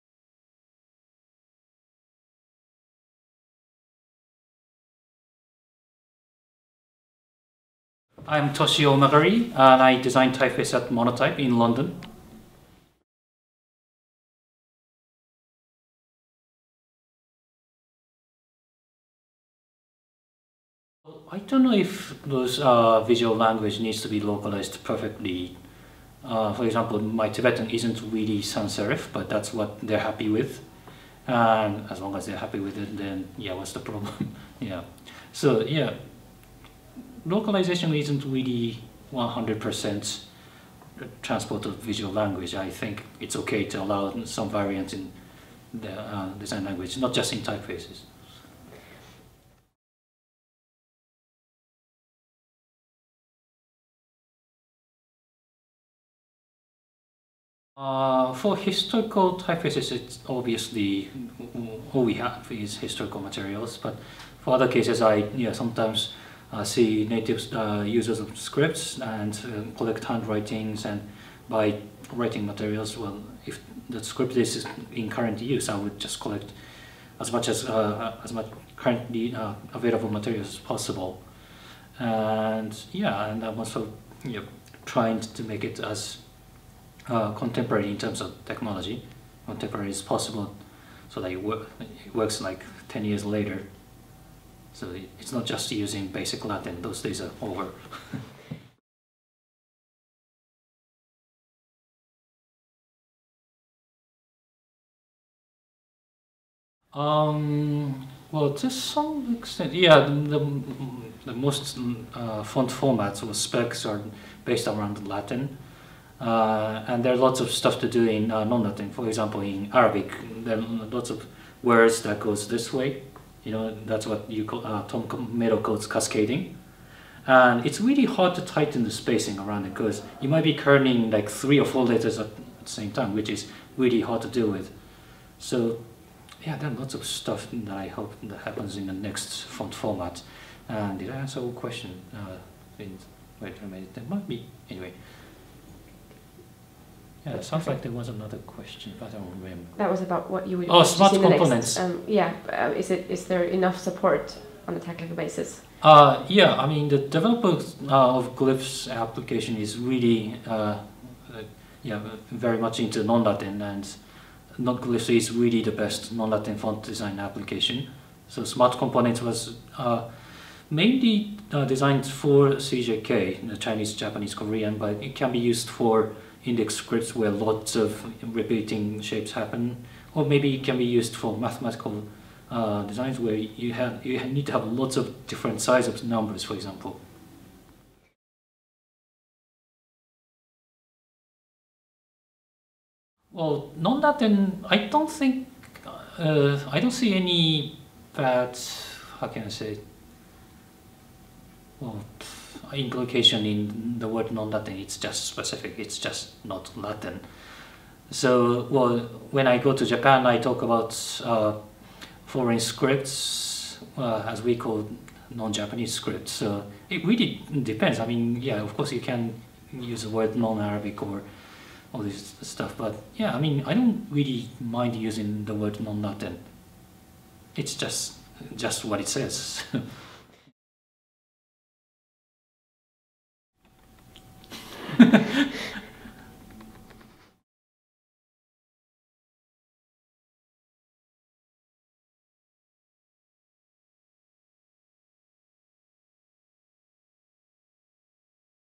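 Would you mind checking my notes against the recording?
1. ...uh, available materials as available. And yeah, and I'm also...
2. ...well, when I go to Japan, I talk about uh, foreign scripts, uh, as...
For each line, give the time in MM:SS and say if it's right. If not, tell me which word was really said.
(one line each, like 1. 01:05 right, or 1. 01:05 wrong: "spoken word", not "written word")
1. 01:19 wrong: "possible", not "available"
2. 03:28 right.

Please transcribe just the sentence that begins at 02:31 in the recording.
Next, um, yeah, uh, is it is there enough support on a technical basis?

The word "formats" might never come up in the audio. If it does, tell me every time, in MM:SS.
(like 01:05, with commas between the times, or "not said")
01:52, 02:19.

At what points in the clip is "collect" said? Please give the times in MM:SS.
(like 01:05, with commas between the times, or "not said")
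01:09, 01:16.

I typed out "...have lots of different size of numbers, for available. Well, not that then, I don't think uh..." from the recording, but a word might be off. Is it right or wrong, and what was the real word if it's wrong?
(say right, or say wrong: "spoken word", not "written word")
wrong: "example", not "available".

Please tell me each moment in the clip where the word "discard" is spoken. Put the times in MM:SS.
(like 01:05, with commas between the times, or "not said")
not said.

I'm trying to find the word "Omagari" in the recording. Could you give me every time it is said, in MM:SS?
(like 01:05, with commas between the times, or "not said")
00:08.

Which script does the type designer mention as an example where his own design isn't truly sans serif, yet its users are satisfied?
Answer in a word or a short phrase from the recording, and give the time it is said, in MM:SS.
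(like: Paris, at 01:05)
Tibetan, at 00:27.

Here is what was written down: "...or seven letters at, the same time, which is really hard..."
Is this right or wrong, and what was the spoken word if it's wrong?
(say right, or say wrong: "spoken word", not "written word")
wrong: "four", not "seven".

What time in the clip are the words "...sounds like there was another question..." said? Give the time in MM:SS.
02:27.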